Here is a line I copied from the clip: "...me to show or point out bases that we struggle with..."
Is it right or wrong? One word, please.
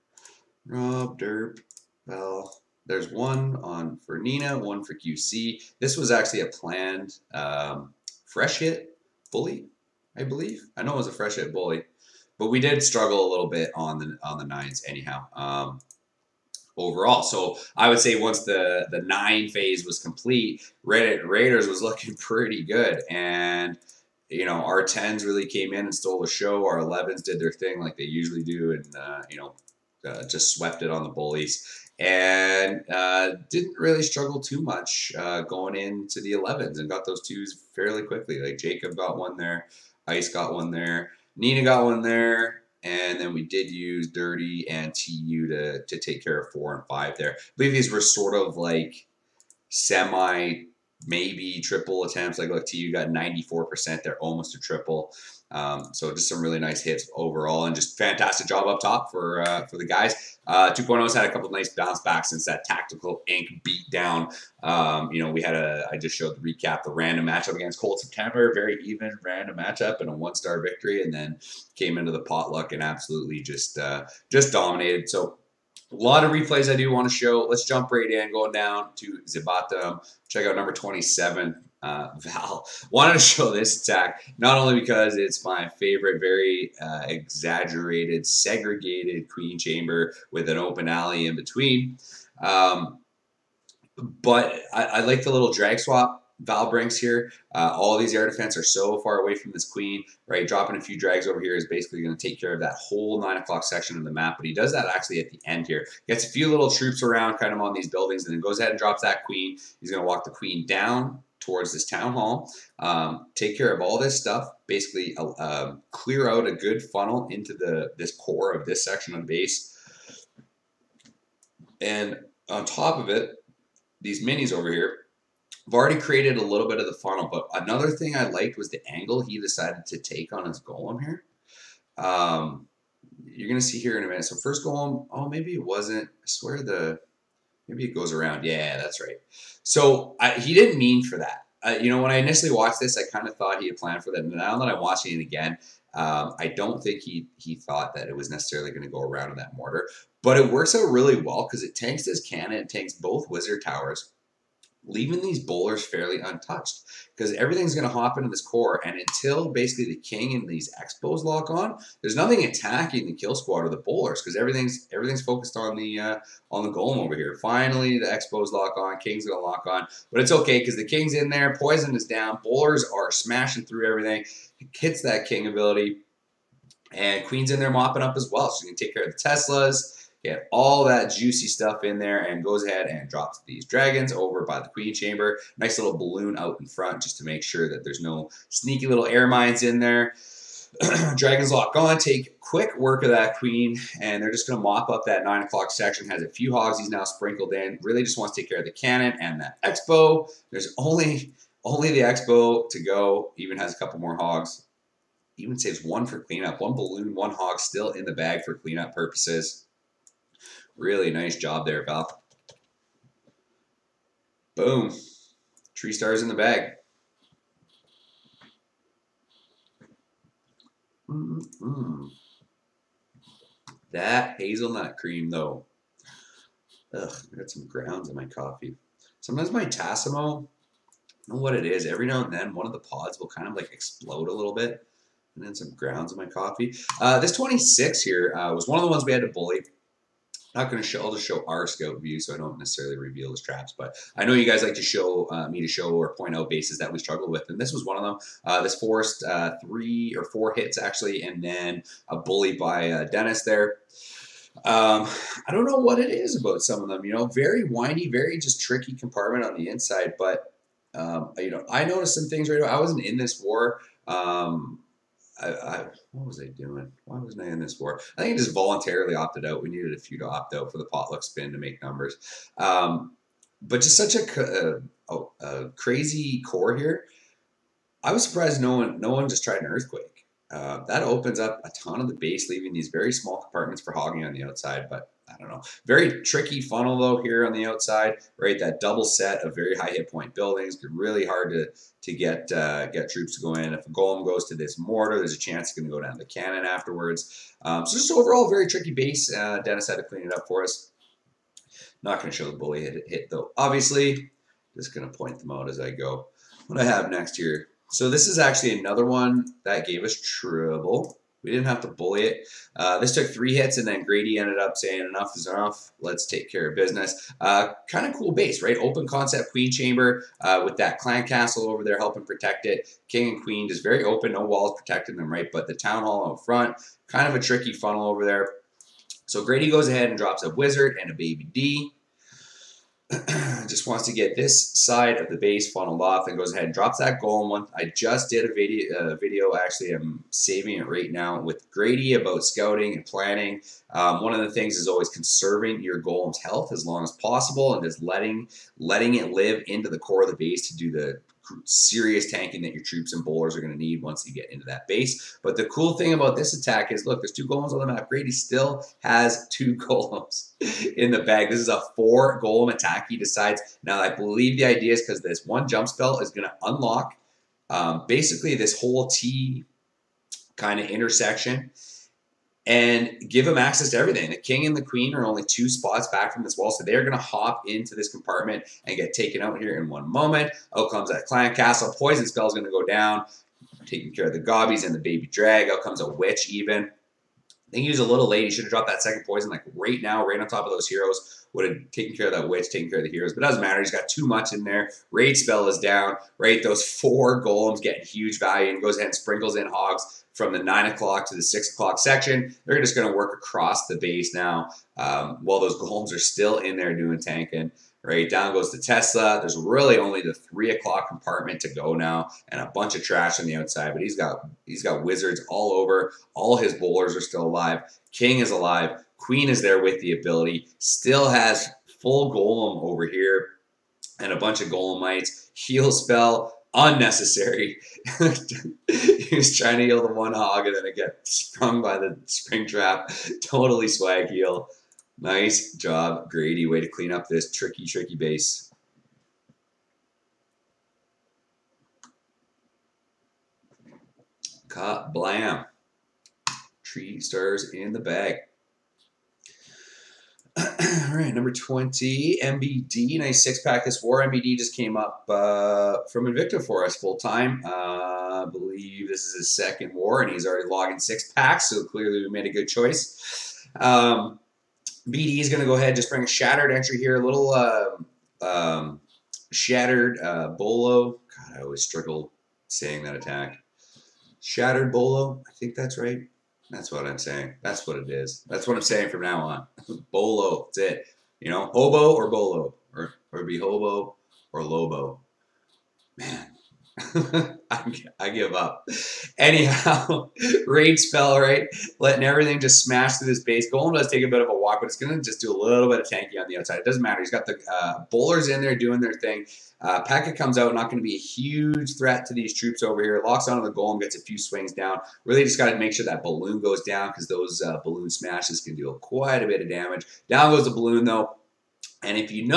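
right.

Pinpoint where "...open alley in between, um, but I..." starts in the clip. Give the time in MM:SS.
01:30.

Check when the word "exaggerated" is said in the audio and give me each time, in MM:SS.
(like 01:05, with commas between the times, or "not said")
01:27.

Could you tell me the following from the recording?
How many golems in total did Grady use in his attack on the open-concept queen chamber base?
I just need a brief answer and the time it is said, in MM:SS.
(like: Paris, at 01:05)
4, at 06:01.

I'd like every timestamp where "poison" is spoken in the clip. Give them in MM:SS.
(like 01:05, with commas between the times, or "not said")
02:51, 06:21, 06:29.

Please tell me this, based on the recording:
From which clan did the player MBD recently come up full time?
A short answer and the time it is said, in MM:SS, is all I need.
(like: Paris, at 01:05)
Invicta, at 07:36.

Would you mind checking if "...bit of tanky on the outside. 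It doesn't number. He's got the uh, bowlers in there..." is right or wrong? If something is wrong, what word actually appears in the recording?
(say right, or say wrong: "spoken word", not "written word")
wrong: "matter", not "number".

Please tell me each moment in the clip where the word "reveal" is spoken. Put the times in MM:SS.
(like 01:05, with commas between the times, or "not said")
04:02.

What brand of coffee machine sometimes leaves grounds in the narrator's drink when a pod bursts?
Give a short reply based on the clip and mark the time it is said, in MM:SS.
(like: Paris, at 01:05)
Tassimo, at 03:49.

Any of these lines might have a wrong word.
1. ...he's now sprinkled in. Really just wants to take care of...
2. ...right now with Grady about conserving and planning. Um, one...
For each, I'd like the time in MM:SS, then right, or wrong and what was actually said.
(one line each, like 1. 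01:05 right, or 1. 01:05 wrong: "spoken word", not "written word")
1. 03:16 right
2. 05:40 wrong: "scouting", not "conserving".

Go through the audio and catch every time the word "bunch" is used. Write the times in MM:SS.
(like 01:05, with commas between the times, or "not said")
06:52, 07:04.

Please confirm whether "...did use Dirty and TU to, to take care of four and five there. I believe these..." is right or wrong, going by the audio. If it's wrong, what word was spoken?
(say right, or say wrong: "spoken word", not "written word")
right.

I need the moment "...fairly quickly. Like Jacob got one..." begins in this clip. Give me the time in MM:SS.
00:37.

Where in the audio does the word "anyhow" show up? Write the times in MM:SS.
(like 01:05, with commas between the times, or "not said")
00:14, 08:09.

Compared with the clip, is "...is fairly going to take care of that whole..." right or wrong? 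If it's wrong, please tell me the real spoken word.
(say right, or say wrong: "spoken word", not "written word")
wrong: "basically", not "fairly".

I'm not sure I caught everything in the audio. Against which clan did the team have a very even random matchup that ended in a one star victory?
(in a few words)
Cold September.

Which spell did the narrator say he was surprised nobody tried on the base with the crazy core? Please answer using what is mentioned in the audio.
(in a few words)
Earthquake.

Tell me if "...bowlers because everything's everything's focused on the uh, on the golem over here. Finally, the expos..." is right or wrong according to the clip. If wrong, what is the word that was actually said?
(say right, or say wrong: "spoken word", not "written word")
right.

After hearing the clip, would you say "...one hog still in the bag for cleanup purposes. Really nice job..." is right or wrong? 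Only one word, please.
right.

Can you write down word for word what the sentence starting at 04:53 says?
If a golem goes to this mortar, there's a chance it's going to go down the cannon afterwards.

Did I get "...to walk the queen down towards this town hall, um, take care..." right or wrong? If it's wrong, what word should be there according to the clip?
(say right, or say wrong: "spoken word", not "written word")
right.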